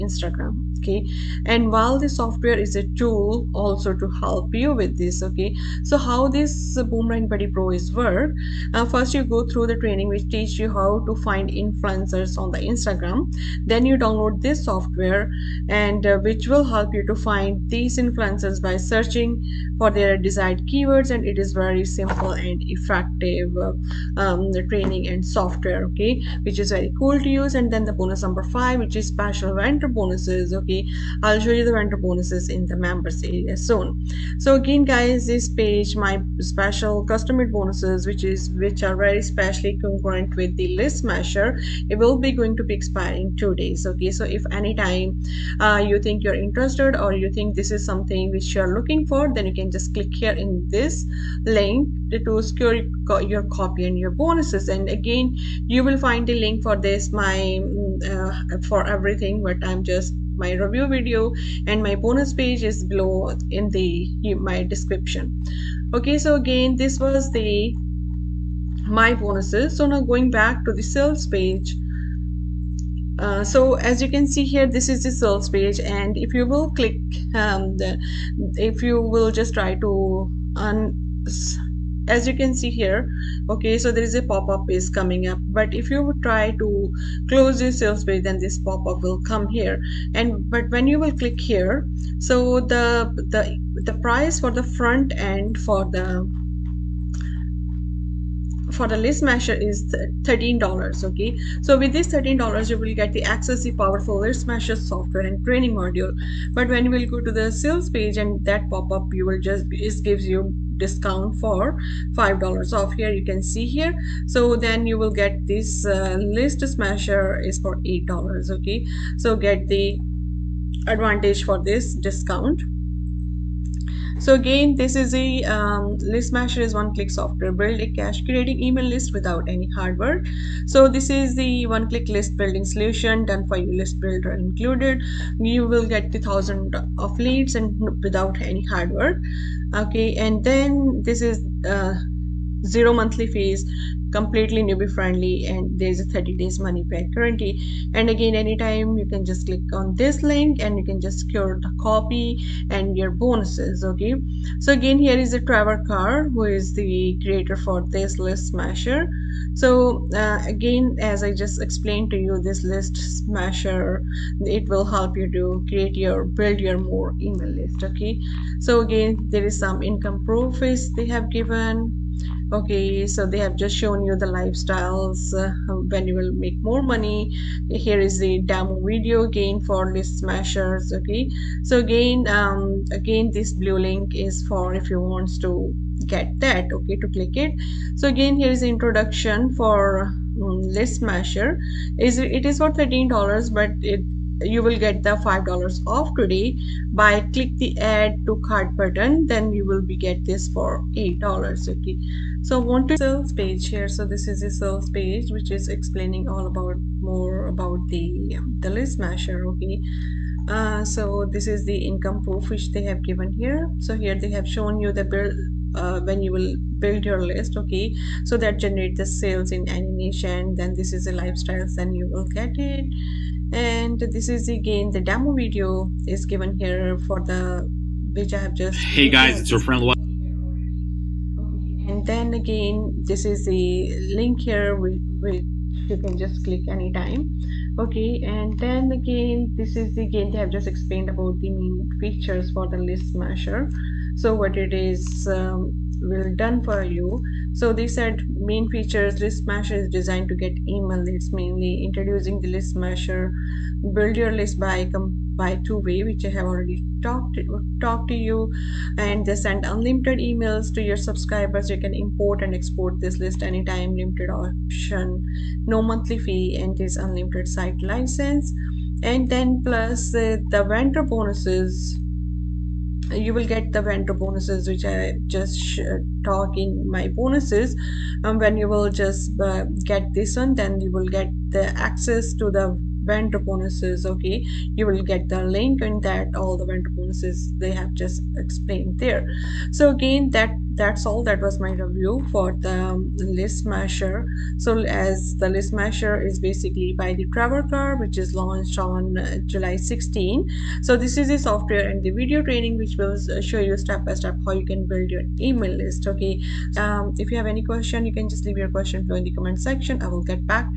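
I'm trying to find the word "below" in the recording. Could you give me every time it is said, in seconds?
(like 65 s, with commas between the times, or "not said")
62 s, 309 s.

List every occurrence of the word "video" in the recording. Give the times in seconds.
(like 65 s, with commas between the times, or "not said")
60 s, 178 s, 225 s, 302 s.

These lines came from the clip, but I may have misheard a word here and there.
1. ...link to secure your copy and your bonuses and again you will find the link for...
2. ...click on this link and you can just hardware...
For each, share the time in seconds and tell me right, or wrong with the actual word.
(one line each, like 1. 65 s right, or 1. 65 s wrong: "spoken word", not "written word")
1. 51 s right
2. 149 s wrong: "secure", not "hardware".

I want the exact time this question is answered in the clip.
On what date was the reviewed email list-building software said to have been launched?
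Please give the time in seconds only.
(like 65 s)
299 s.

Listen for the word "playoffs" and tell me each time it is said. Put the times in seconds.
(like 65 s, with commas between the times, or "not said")
not said.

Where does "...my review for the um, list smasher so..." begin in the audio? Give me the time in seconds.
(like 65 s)
291 s.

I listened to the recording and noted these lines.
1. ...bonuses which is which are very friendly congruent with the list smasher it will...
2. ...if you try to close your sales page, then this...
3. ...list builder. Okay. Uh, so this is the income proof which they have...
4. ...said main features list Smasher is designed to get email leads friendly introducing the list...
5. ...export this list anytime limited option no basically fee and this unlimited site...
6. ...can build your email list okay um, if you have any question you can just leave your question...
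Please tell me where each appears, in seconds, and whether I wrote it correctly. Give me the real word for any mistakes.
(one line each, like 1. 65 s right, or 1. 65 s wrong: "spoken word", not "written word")
1. 37 s wrong: "specially", not "friendly"
2. 85 s right
3. 208 s wrong: "smasher", not "builder"
4. 247 s wrong: "mainly", not "friendly"
5. 262 s wrong: "monthly", not "basically"
6. 304 s right.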